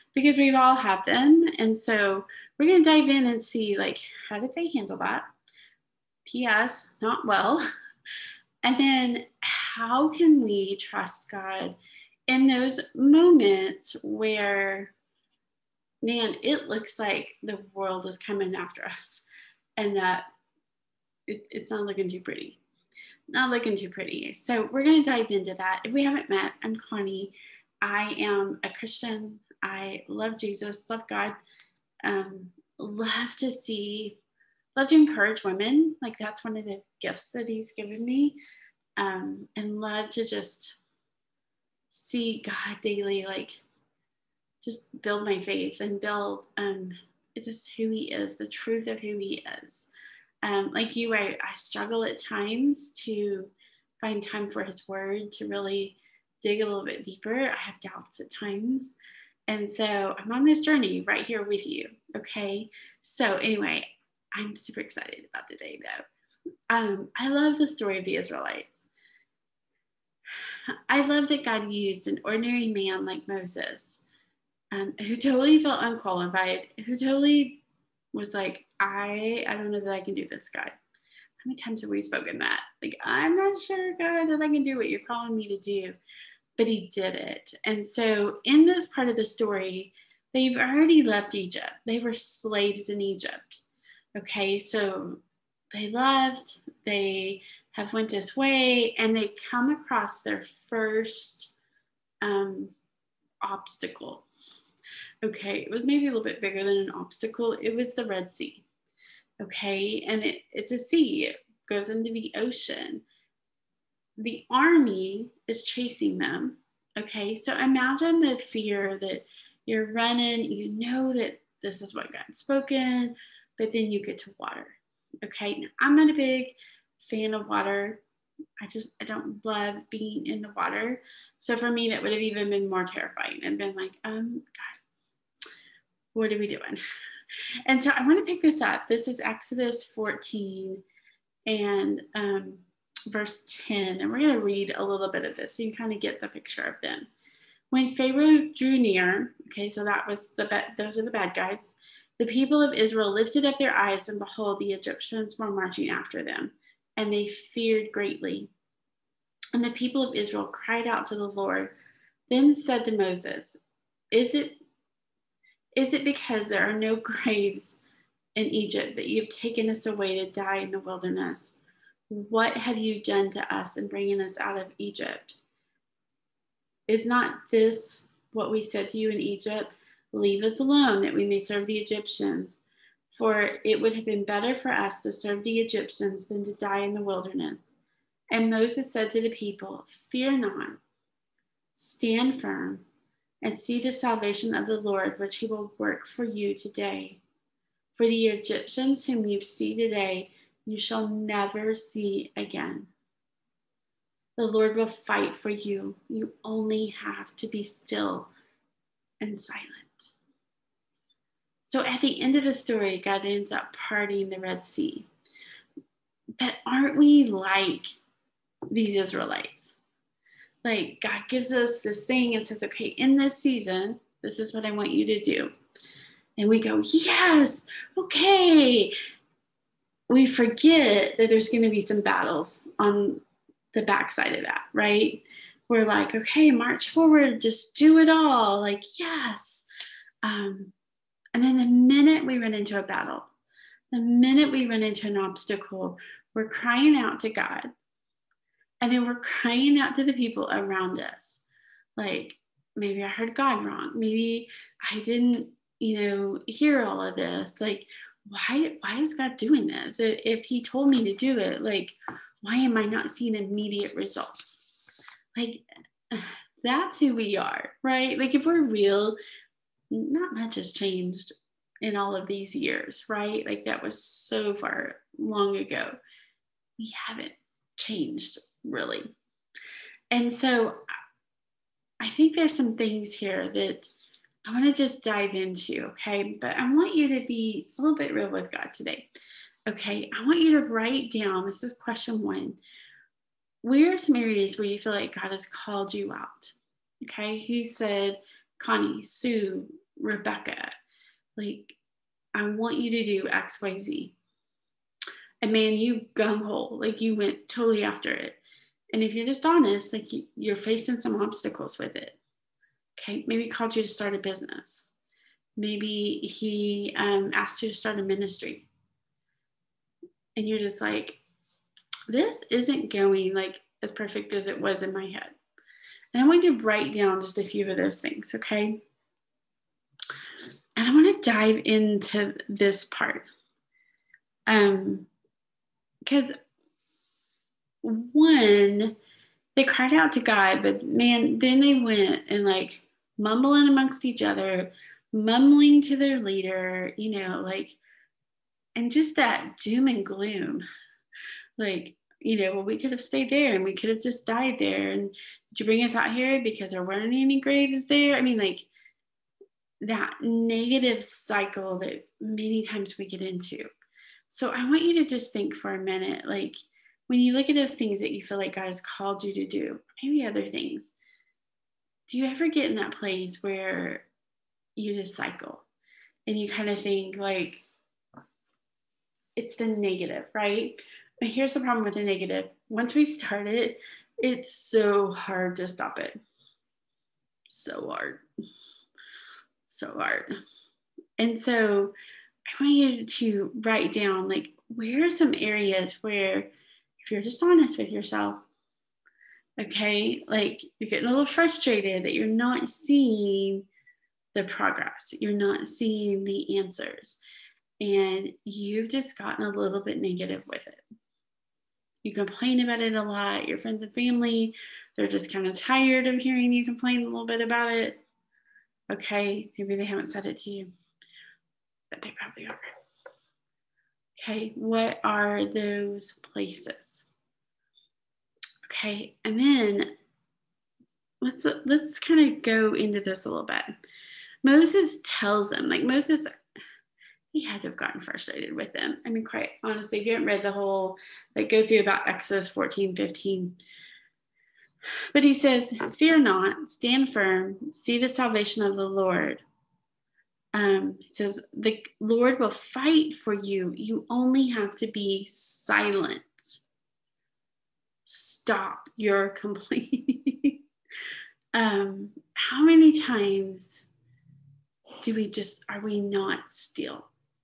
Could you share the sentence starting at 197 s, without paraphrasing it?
For the Egyptians whom you see today, you shall never see again.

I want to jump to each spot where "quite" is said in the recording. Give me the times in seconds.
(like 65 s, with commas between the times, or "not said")
439 s.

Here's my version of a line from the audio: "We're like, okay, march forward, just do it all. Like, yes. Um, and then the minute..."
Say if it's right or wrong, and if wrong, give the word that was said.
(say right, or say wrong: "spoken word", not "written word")
right.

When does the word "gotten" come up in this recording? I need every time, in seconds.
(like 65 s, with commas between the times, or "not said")
409 s, 437 s.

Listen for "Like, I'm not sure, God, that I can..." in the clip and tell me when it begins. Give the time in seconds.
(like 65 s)
82 s.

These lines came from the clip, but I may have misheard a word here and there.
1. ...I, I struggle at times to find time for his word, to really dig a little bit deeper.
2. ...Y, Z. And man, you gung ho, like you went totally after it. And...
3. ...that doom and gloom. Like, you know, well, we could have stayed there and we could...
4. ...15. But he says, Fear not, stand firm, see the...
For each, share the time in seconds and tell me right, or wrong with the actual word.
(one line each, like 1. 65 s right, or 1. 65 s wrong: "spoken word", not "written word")
1. 51 s right
2. 303 s right
3. 349 s right
4. 442 s right.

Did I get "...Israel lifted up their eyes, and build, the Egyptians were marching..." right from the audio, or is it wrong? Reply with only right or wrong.
wrong.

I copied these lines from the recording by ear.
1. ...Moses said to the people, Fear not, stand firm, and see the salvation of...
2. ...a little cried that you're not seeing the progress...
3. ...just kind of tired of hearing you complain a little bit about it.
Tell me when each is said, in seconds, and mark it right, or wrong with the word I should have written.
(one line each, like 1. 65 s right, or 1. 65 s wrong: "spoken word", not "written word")
1. 188 s right
2. 401 s wrong: "frustrated", not "cried"
3. 415 s right.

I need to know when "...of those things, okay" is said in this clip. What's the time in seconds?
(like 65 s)
327 s.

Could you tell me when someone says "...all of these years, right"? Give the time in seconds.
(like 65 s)
271 s.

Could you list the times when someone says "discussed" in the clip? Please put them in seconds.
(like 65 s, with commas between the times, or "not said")
not said.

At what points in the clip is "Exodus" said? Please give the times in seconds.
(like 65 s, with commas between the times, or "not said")
139 s, 442 s.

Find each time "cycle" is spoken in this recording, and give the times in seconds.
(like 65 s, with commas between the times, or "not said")
361 s, 375 s.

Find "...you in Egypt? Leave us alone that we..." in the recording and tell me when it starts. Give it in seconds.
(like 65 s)
178 s.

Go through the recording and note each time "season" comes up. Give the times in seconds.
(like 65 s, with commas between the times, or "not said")
223 s.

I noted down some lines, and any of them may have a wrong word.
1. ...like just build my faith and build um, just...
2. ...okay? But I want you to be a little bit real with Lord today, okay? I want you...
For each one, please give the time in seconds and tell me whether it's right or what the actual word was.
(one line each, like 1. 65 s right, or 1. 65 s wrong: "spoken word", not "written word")
1. 43 s right
2. 285 s wrong: "God", not "Lord".